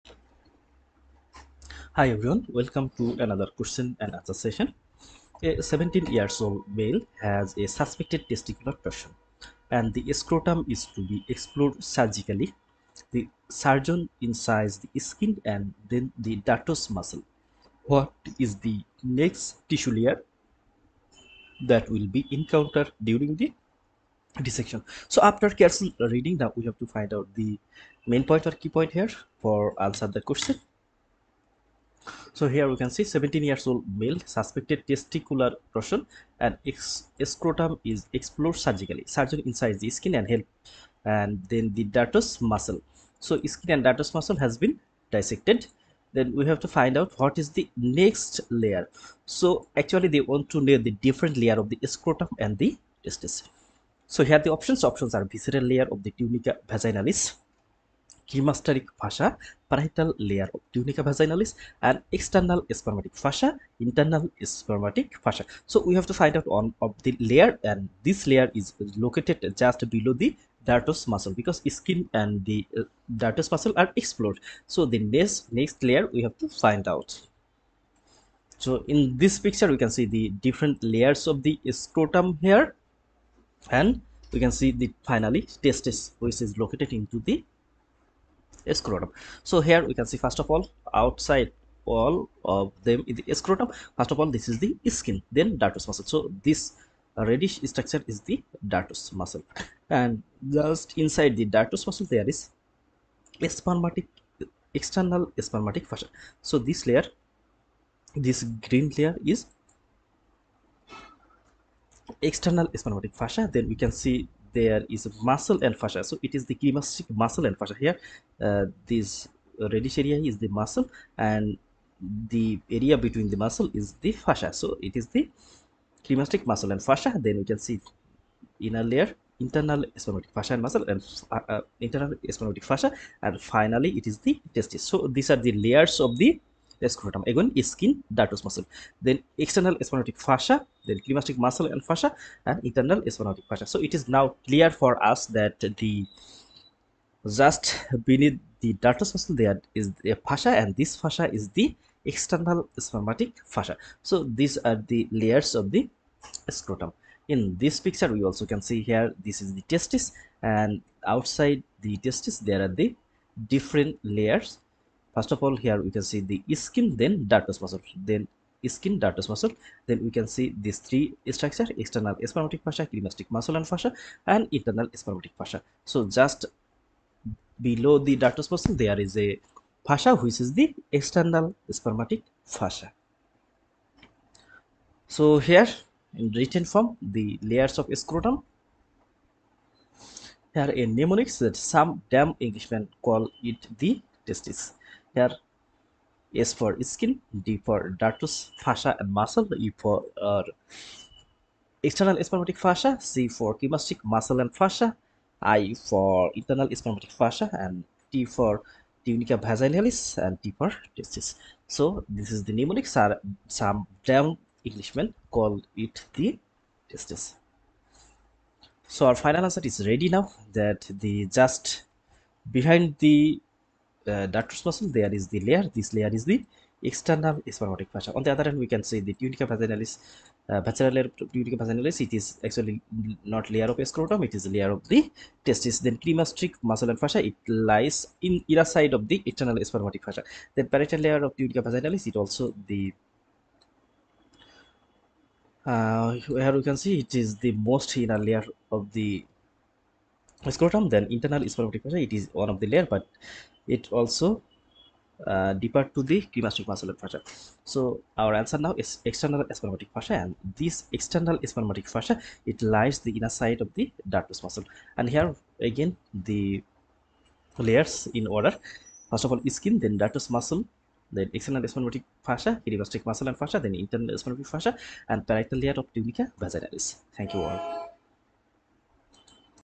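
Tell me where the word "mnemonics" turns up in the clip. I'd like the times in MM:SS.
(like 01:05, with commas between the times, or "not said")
03:10, 03:32.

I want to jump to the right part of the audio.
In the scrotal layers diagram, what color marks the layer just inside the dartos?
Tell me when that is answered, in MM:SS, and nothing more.
01:48.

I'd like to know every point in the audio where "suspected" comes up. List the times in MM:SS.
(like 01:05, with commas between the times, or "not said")
00:07, 00:34.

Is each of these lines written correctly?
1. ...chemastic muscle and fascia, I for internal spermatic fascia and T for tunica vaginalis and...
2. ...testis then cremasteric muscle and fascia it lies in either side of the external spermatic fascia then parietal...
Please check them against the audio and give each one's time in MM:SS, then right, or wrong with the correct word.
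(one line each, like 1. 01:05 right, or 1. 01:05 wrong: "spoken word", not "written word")
1. 03:23 right
2. 03:55 right.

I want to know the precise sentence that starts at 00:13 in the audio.
The surgeon incises the skin and then the dartos muscle.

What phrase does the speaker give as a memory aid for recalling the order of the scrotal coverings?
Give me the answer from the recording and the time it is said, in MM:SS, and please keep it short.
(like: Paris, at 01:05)
Some damn Englishmen call it the testis, at 03:11.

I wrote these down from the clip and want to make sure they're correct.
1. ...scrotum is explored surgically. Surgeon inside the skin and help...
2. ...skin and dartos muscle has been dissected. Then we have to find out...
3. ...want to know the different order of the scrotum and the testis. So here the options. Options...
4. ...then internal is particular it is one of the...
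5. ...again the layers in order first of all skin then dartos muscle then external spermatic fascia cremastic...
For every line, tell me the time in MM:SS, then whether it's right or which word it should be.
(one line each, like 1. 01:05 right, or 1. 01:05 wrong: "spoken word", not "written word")
1. 00:37 right
2. 00:43 right
3. 00:50 wrong: "layer", not "order"
4. 04:10 right
5. 04:25 right.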